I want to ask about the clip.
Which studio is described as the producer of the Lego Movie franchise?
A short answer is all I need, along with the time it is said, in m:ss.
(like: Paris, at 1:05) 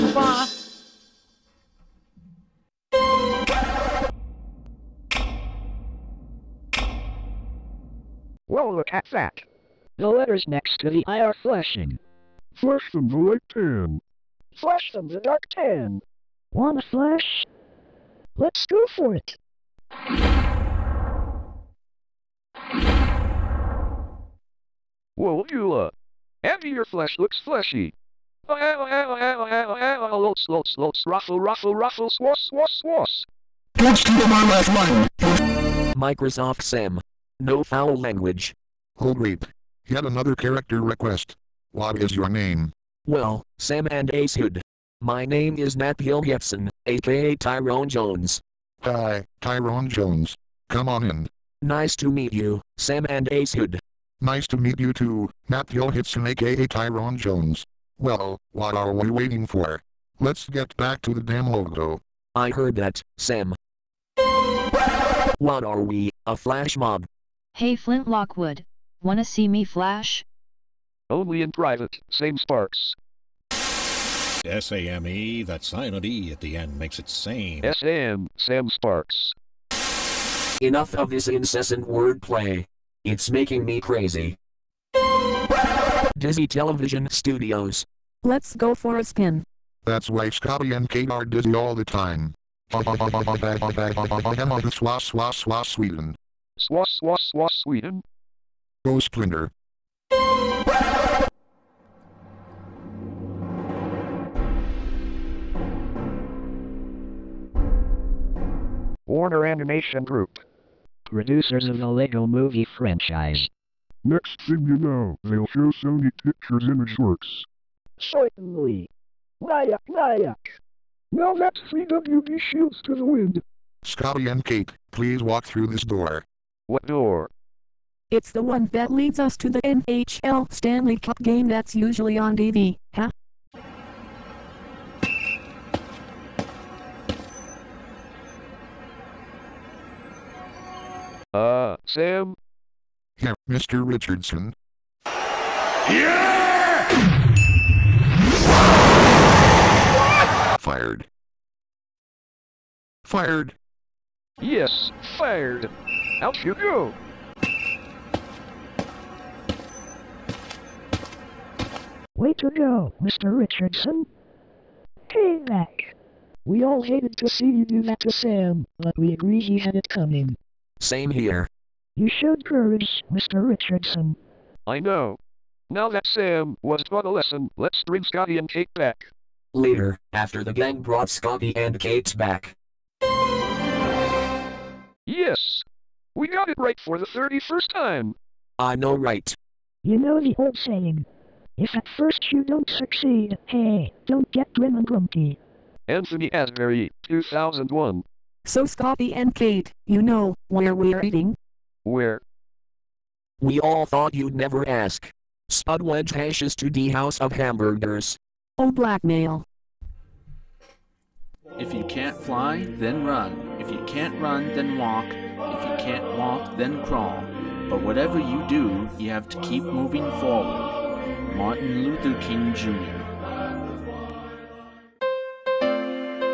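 Warner Animation Group, at 1:49.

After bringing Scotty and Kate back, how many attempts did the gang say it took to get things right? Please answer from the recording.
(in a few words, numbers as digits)
31.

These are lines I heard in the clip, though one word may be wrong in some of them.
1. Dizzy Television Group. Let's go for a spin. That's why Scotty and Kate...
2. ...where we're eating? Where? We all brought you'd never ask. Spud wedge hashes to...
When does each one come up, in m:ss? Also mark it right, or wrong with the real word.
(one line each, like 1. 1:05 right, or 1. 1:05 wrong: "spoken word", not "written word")
1. 1:26 wrong: "Studios", not "Group"
2. 3:20 wrong: "thought", not "brought".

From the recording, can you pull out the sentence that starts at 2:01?
Now that's CWD shields to the wind.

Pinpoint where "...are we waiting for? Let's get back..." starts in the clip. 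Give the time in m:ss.
0:58.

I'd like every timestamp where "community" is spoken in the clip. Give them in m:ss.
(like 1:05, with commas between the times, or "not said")
not said.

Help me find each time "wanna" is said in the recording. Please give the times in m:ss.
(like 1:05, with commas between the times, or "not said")
0:16, 1:09.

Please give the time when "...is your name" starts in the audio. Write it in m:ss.
0:41.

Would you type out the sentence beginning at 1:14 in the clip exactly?
S-A-M-E, that silent E at the end makes it same.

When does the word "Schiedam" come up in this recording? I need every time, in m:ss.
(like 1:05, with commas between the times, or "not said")
not said.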